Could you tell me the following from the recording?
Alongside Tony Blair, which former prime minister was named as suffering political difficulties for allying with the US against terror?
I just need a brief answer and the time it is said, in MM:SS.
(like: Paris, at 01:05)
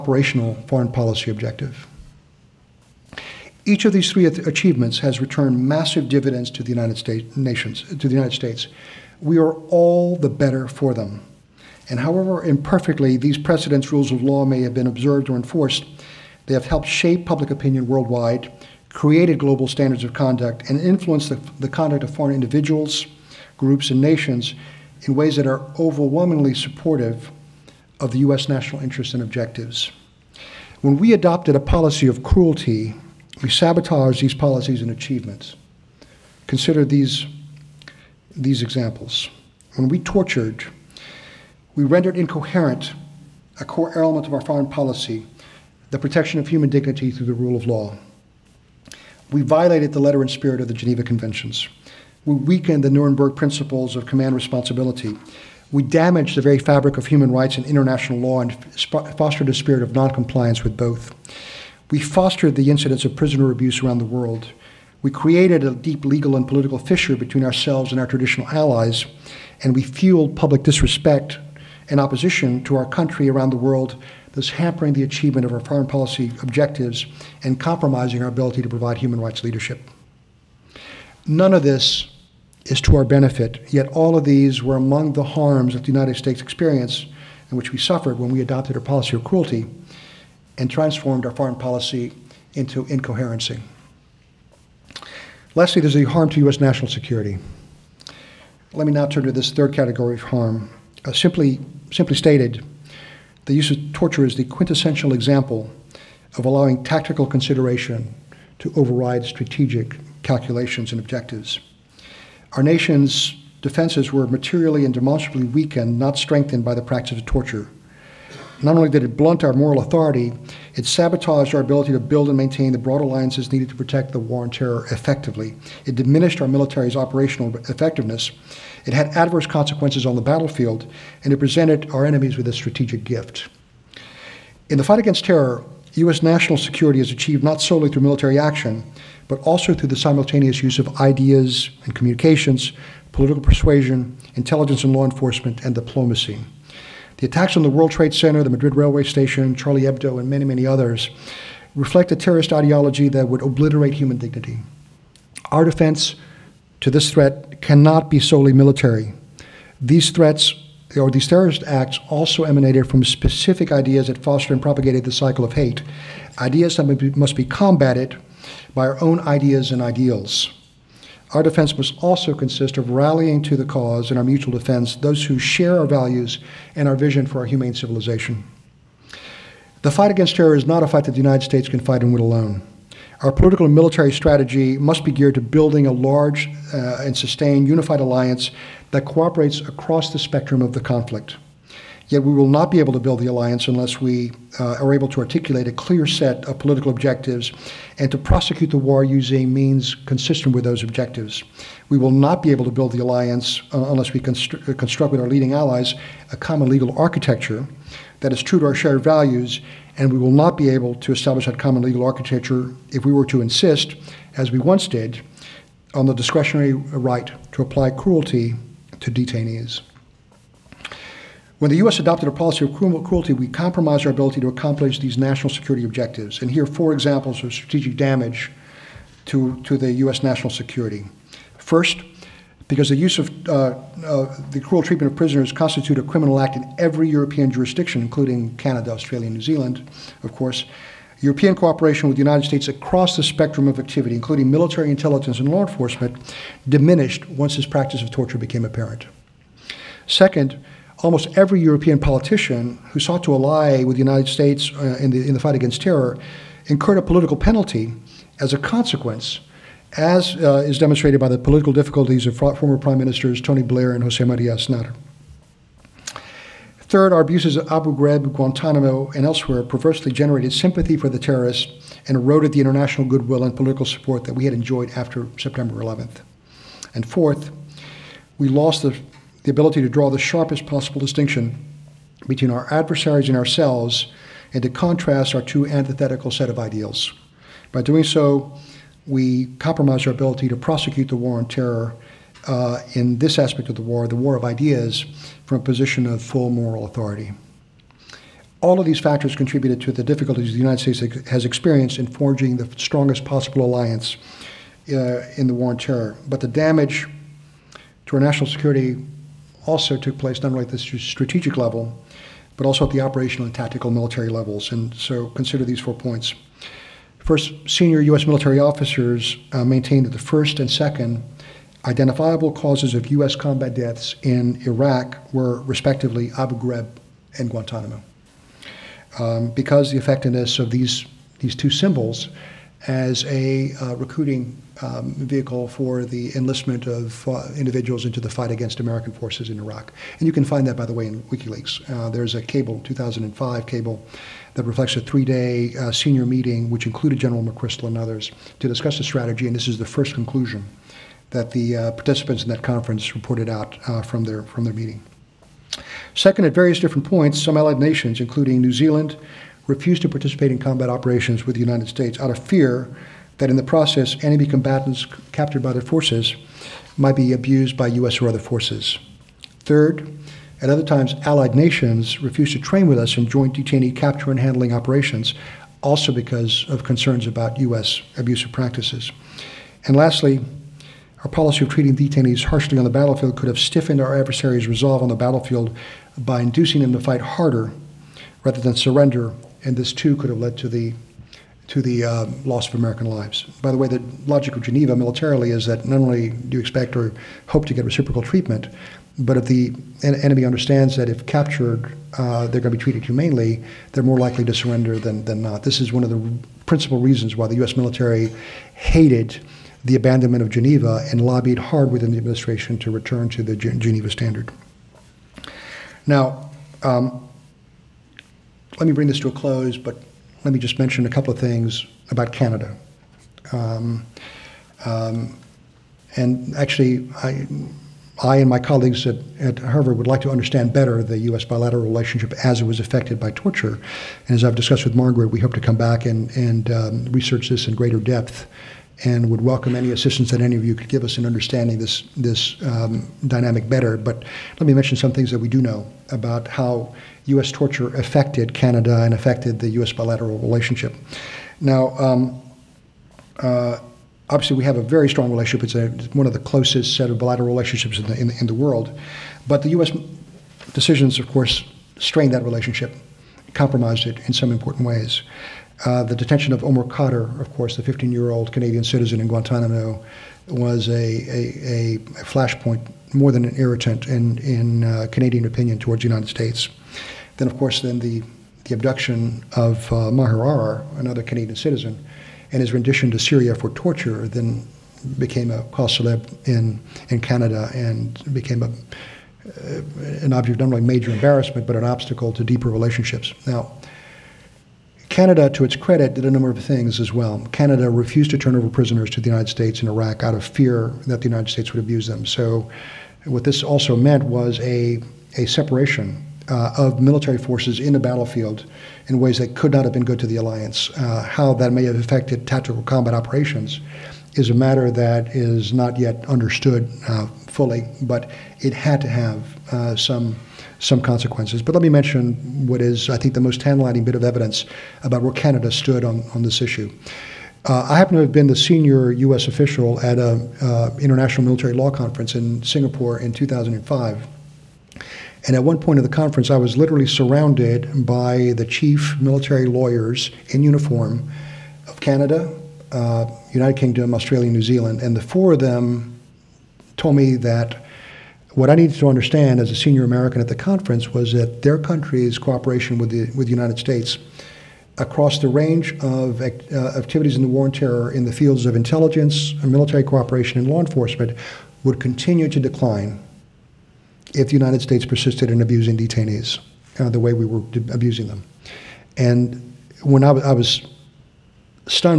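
Jose Maria Aznar, at 04:24.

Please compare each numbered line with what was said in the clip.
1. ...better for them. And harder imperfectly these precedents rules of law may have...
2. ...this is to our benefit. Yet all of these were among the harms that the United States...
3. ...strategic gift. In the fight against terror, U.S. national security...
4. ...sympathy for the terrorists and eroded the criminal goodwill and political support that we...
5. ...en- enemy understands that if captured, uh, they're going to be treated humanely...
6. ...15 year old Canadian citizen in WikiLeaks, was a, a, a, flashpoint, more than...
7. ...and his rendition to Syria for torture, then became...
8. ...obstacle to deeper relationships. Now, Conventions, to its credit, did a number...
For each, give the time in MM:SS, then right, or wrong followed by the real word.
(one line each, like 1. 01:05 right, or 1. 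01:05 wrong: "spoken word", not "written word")
1. 00:10 wrong: "however", not "harder"
2. 01:21 right
3. 02:12 right
4. 04:30 wrong: "international", not "criminal"
5. 06:40 right
6. 07:47 wrong: "Guantanamo", not "WikiLeaks"
7. 08:02 right
8. 08:11 wrong: "Canada", not "Conventions".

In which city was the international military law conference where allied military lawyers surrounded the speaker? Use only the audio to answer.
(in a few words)
Singapore.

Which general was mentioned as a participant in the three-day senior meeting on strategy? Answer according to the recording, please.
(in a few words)
General McChrystal.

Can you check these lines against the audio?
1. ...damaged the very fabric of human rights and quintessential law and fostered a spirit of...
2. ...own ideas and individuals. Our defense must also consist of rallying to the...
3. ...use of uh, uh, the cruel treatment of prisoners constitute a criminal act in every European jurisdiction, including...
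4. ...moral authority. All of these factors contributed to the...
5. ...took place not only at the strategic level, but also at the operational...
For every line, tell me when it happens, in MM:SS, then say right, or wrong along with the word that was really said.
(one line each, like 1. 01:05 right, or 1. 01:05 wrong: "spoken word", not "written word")
1. 00:55 wrong: "international", not "quintessential"
2. 02:49 wrong: "ideals", not "individuals"
3. 03:52 right
4. 04:56 right
5. 05:09 right.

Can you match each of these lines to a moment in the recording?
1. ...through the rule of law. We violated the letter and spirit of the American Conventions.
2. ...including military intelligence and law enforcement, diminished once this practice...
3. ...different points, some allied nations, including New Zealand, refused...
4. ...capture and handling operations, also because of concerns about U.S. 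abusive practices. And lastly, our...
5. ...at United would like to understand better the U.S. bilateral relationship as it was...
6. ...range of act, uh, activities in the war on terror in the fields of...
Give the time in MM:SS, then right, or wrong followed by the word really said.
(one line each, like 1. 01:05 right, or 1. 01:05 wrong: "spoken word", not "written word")
1. 00:47 wrong: "Geneva", not "American"
2. 04:04 right
3. 05:56 right
4. 06:13 right
5. 07:09 wrong: "Harvard", not "United"
6. 09:15 right.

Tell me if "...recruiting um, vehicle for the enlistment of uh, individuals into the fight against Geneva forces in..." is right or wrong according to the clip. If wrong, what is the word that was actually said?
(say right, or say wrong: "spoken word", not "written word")
wrong: "American", not "Geneva".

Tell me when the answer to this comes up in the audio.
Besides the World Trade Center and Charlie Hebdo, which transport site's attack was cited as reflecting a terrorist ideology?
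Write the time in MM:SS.
02:28.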